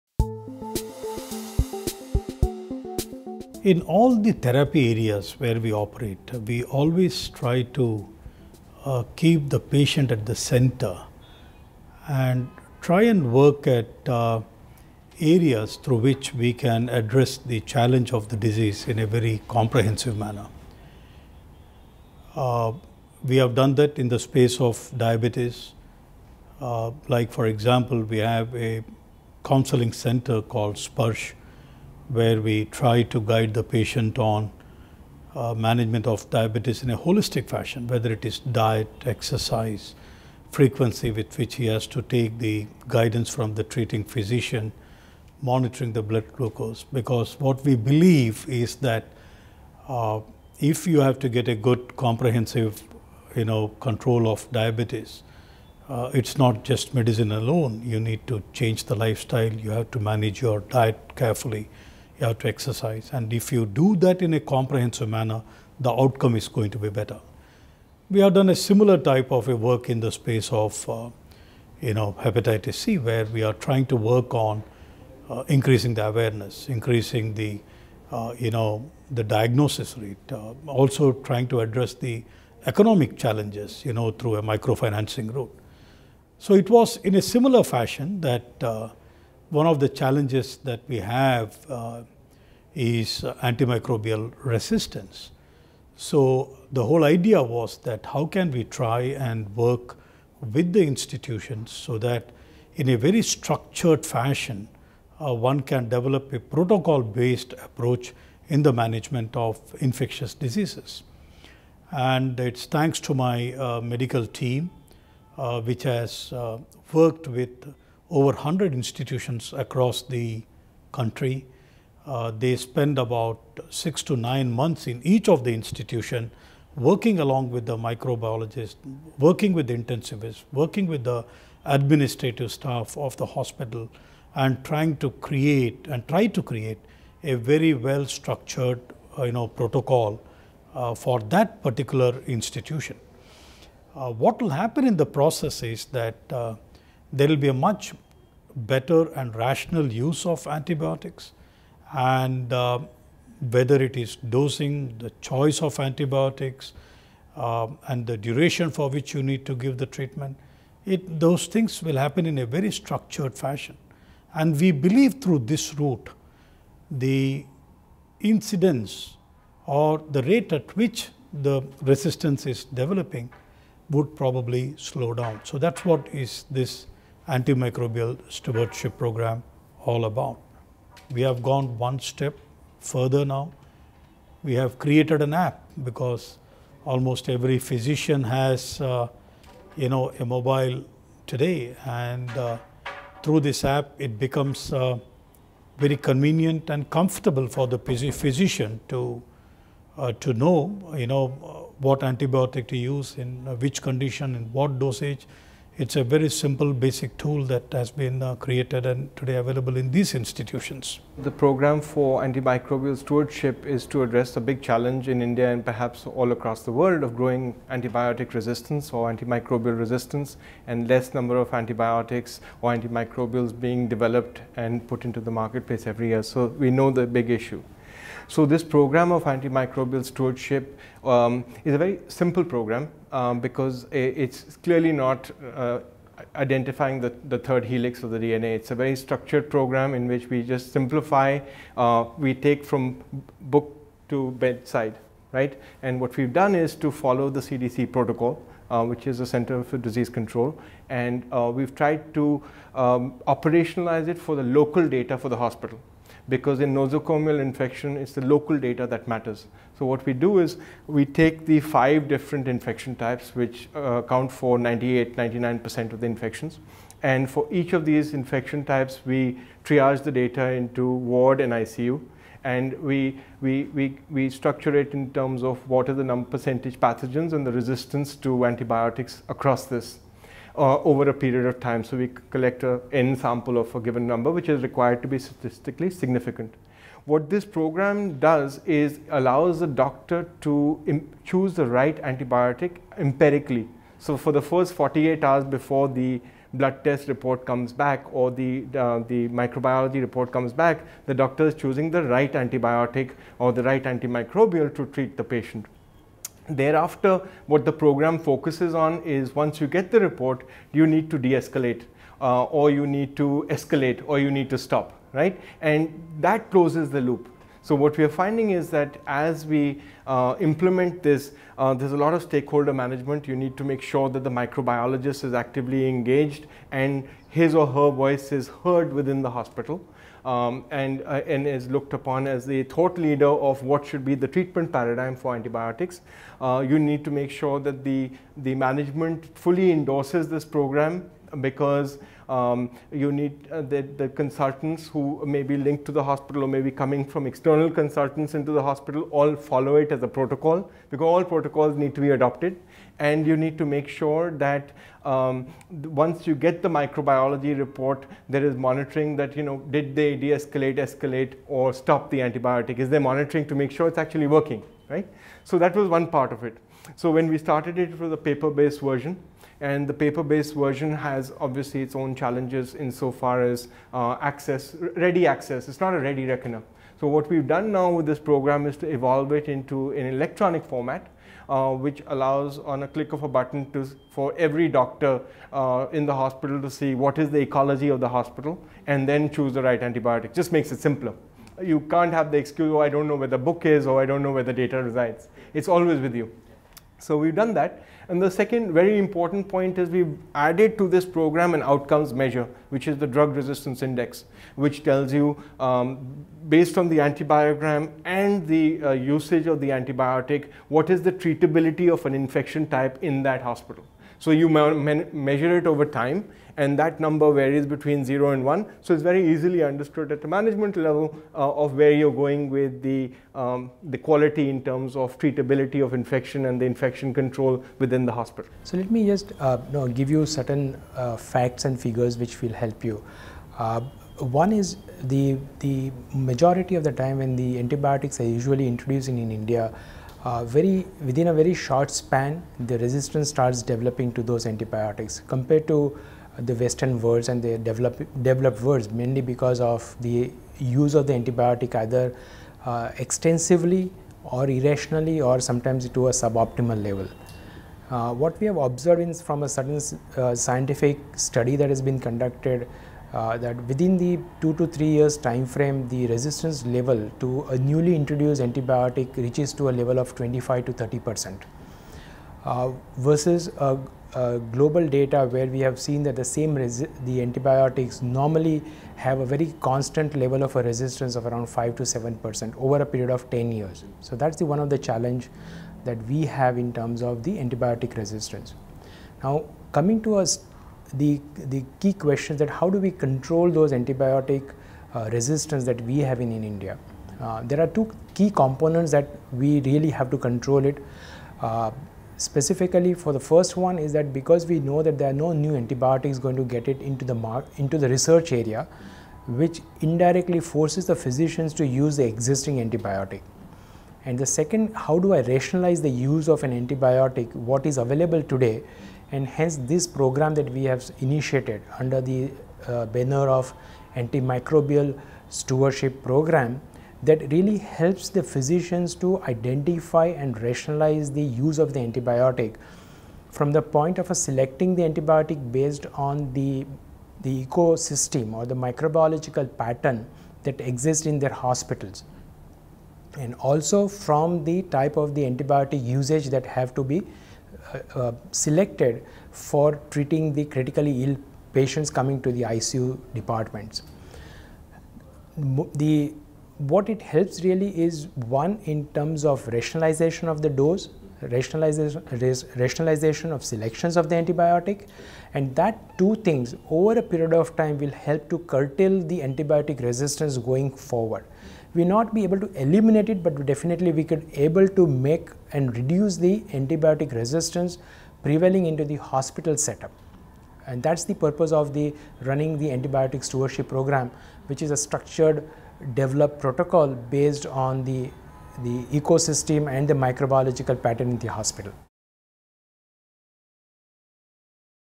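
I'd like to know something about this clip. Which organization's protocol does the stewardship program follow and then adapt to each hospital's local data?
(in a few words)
CDC.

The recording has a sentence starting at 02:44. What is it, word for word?
And we believe through this route, the incidence or the rate at which the resistance is developing would probably slow down.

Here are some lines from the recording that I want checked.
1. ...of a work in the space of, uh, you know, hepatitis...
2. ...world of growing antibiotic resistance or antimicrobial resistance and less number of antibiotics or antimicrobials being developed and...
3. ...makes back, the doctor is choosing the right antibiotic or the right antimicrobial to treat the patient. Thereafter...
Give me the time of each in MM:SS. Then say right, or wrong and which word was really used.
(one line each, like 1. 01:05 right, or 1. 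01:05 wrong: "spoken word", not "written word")
1. 01:09 right
2. 03:36 right
3. 05:00 wrong: "comes", not "makes".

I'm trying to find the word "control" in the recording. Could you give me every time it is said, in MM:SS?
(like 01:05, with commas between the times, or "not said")
00:53, 04:10, 07:07, 08:12, 08:20.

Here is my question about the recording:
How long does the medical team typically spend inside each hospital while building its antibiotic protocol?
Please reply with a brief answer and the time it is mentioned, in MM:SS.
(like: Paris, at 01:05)
6 to 9 months, at 02:03.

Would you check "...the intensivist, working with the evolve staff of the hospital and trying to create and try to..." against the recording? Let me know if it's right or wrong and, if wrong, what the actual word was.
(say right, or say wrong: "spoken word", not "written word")
wrong: "administrative", not "evolve".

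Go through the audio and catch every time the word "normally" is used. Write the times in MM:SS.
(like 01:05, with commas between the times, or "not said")
07:58.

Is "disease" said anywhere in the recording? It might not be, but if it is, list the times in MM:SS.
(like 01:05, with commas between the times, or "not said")
00:18, 01:50, 04:09.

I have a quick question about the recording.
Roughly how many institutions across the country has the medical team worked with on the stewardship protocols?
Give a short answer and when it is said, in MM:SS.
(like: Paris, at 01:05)
Over 100, at 01:58.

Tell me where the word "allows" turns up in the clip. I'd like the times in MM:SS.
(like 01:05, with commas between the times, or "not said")
04:49, 06:22.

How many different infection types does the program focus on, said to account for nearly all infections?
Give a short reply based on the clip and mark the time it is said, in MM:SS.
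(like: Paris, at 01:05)
5, at 04:21.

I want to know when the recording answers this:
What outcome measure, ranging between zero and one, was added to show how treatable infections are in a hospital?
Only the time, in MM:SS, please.
06:43.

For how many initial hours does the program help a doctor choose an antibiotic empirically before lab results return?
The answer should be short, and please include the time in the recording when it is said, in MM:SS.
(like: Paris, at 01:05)
48, at 04:54.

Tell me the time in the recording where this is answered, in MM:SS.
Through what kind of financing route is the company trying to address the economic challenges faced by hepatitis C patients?
01:24.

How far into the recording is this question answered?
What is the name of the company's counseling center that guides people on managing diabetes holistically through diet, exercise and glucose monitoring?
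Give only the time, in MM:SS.
00:30.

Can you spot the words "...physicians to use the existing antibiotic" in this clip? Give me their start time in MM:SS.
08:30.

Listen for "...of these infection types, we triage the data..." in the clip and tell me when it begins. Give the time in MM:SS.
04:27.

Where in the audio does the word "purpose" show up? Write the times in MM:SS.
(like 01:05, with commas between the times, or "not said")
09:41.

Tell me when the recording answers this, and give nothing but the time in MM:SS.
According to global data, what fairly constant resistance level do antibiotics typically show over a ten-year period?
08:01.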